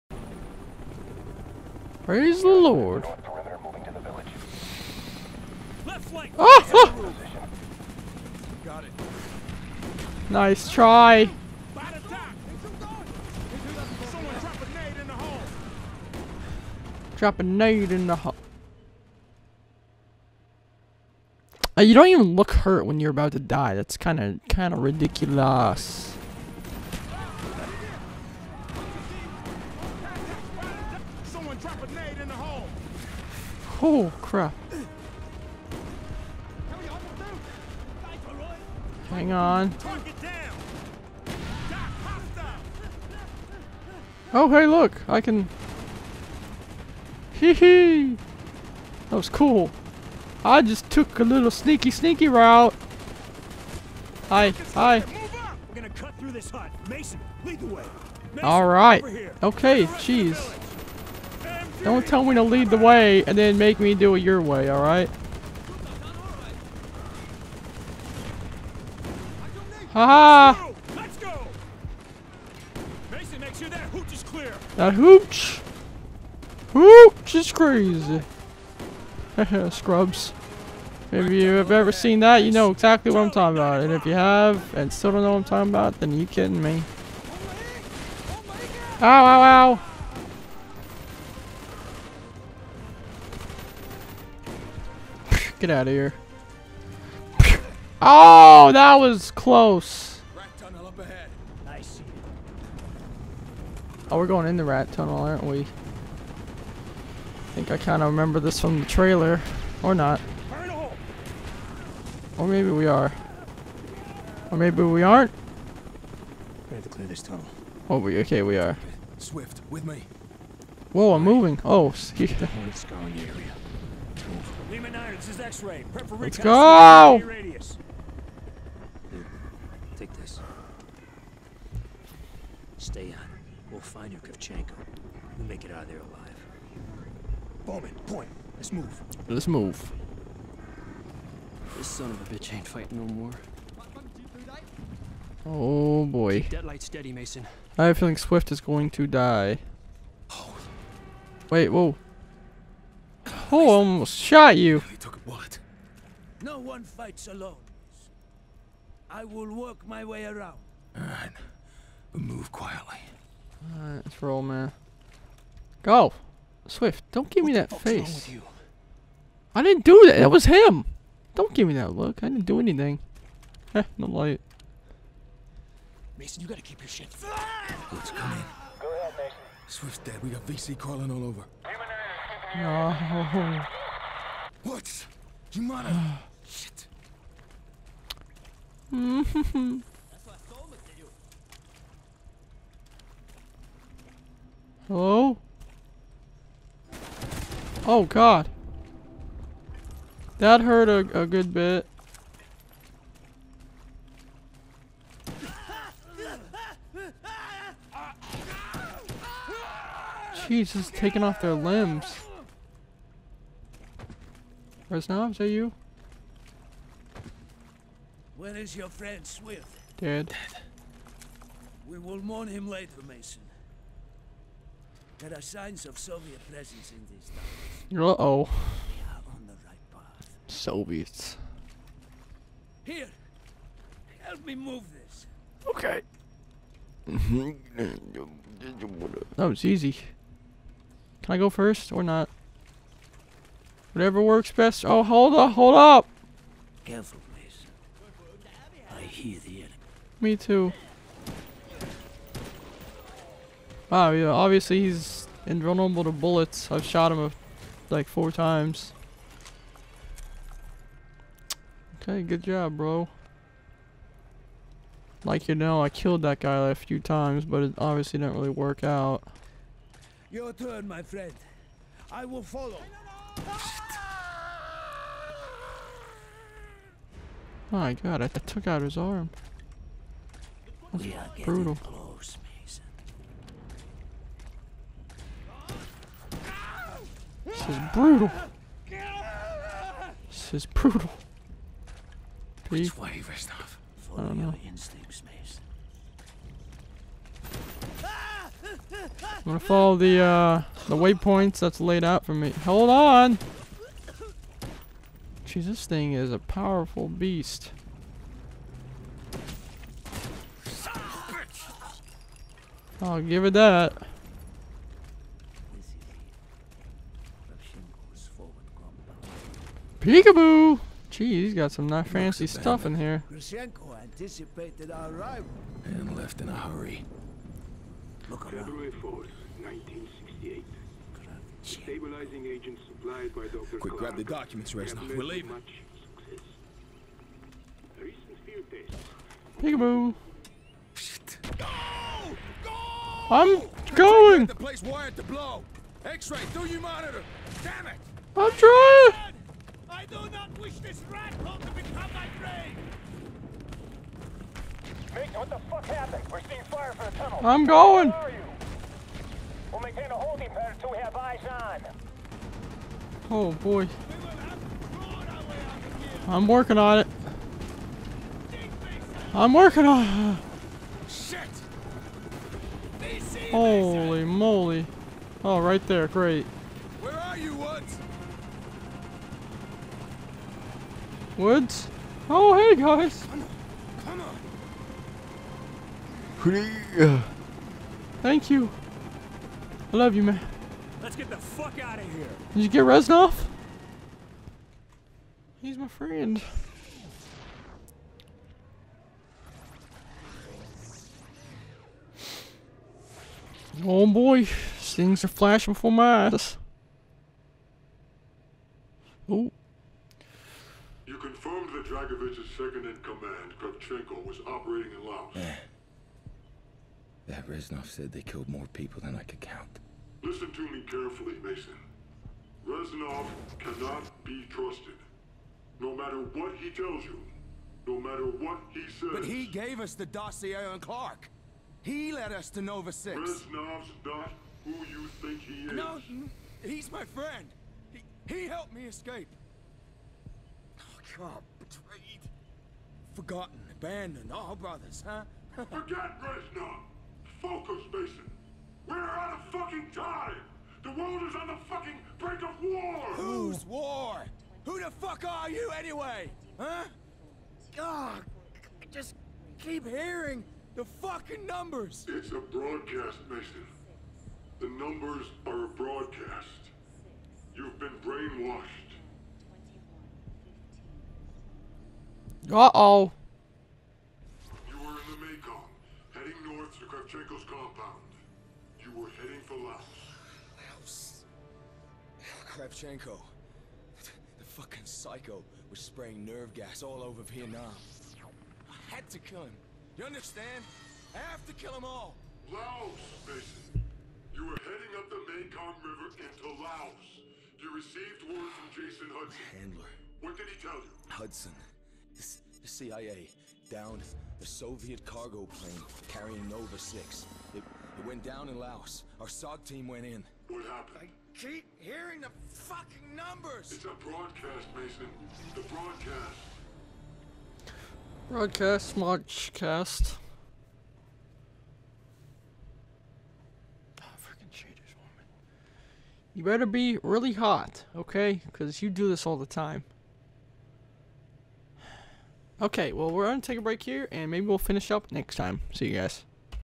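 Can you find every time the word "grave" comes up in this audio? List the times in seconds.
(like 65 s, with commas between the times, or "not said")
352 s.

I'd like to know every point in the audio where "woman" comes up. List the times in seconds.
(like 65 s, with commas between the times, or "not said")
524 s.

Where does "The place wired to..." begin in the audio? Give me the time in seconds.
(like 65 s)
344 s.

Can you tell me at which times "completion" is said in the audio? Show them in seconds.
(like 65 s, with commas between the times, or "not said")
not said.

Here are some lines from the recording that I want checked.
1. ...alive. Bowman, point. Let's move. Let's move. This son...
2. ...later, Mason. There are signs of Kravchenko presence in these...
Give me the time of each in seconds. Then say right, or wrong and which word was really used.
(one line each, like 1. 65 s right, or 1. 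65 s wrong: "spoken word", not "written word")
1. 135 s right
2. 222 s wrong: "Soviet", not "Kravchenko".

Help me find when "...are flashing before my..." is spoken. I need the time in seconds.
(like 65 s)
405 s.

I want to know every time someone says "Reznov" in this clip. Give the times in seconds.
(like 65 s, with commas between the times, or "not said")
214 s, 293 s, 334 s, 392 s, 417 s, 422 s, 433 s, 446 s.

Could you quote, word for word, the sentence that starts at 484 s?
The fucking psycho was spraying nerve gas all over Vietnam.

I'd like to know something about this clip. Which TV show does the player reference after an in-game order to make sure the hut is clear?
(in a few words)
Scrubs.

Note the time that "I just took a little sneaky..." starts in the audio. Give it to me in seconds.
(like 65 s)
50 s.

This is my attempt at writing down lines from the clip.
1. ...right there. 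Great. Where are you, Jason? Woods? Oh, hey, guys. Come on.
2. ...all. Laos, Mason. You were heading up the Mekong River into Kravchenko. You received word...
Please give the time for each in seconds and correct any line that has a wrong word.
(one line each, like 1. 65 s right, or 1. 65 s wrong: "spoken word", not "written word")
1. 375 s wrong: "Woods", not "Jason"
2. 491 s wrong: "Laos", not "Kravchenko".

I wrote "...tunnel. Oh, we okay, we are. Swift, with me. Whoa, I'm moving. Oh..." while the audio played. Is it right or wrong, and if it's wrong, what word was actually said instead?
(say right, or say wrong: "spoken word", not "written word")
right.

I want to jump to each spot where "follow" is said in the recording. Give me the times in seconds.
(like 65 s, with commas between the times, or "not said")
272 s, 294 s, 299 s.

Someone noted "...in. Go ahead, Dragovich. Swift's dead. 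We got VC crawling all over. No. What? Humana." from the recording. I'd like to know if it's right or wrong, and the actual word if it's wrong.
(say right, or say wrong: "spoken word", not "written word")
wrong: "Mason", not "Dragovich".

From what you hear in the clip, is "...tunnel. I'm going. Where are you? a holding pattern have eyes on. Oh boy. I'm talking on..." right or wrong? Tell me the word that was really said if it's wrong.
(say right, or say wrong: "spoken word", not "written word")
wrong: "working", not "talking".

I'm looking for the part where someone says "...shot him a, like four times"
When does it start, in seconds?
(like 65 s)
256 s.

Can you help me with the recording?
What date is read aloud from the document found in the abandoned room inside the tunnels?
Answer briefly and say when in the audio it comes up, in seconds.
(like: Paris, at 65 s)
February 4th, 1968, at 328 s.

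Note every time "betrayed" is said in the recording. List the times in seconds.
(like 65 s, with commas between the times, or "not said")
441 s.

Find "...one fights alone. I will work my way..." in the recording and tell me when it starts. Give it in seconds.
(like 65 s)
156 s.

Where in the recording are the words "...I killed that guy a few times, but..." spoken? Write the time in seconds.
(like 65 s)
265 s.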